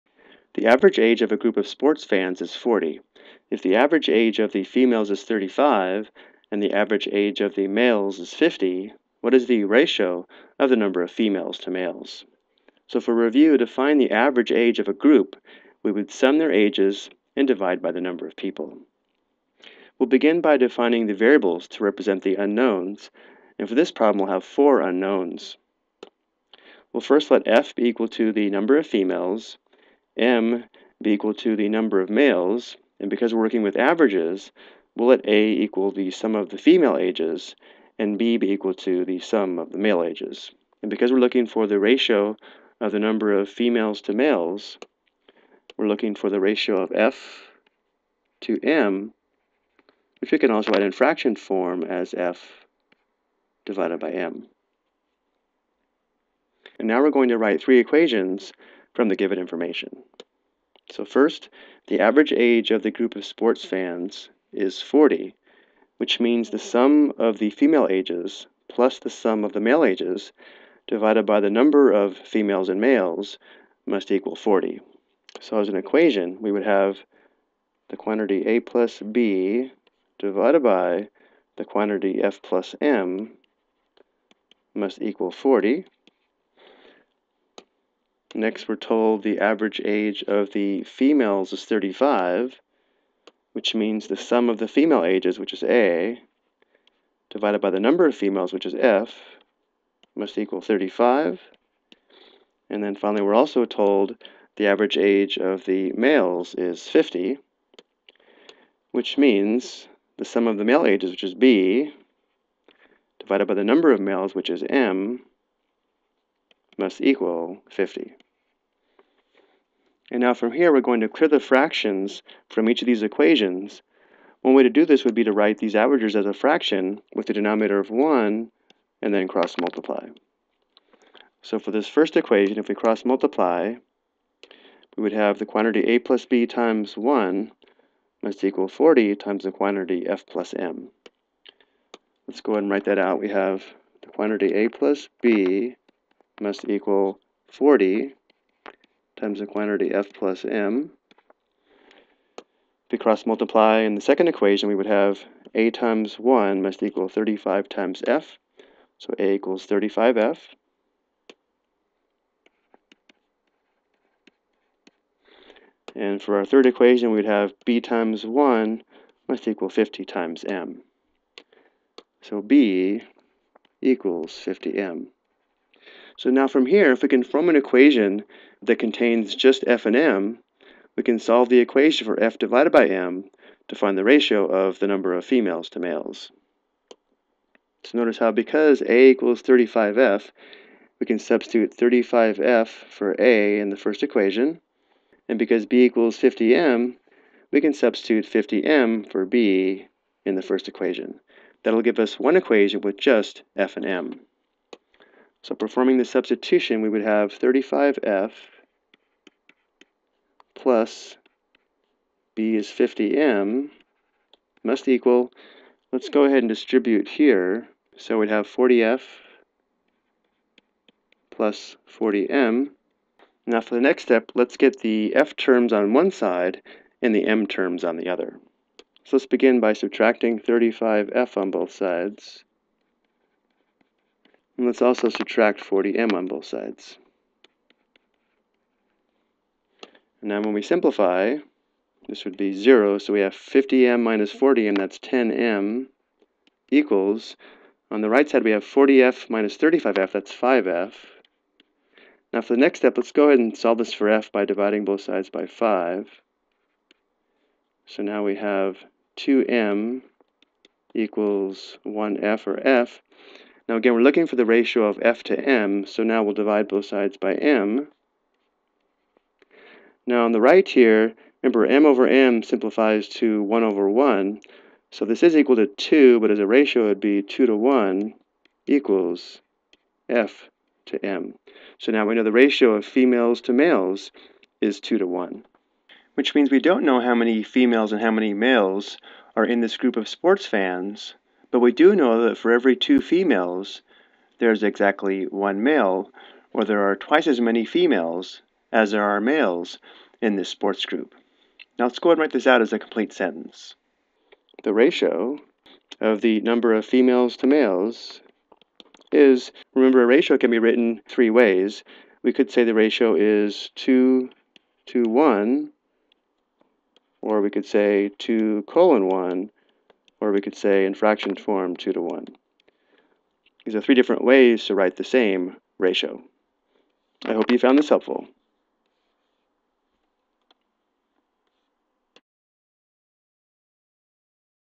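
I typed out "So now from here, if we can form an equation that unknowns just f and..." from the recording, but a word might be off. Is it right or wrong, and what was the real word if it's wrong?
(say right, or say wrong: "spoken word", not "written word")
wrong: "contains", not "unknowns".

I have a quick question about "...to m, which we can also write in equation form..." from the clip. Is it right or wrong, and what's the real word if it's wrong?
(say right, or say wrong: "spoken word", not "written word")
wrong: "fraction", not "equation".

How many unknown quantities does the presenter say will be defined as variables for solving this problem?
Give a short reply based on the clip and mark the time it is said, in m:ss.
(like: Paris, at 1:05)
4, at 0:24.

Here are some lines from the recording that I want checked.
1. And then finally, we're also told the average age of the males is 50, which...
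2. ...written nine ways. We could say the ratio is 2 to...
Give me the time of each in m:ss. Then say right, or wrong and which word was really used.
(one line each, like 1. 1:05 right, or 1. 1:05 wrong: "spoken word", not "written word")
1. 1:42 right
2. 5:10 wrong: "three", not "nine".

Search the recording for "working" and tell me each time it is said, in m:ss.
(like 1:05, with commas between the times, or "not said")
0:33.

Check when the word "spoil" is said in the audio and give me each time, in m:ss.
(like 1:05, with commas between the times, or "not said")
not said.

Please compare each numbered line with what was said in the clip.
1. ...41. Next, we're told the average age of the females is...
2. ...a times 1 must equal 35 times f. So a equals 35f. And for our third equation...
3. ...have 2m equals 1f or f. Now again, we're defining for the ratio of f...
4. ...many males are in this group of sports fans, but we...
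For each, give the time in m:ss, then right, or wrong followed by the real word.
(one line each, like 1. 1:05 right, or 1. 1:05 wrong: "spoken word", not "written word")
1. 1:25 wrong: "40", not "41"
2. 2:35 right
3. 4:18 wrong: "looking", not "defining"
4. 4:48 right.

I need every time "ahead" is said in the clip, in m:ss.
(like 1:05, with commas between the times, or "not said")
2:22, 3:36, 4:13, 5:02.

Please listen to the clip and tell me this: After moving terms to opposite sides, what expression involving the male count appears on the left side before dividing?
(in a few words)
10m.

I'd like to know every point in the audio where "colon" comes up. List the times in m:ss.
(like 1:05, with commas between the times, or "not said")
5:18.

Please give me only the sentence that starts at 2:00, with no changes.
And now from here, we're going to clear the fractions from each of these equations.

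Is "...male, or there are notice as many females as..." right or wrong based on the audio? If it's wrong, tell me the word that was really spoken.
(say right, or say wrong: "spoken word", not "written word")
wrong: "twice", not "notice".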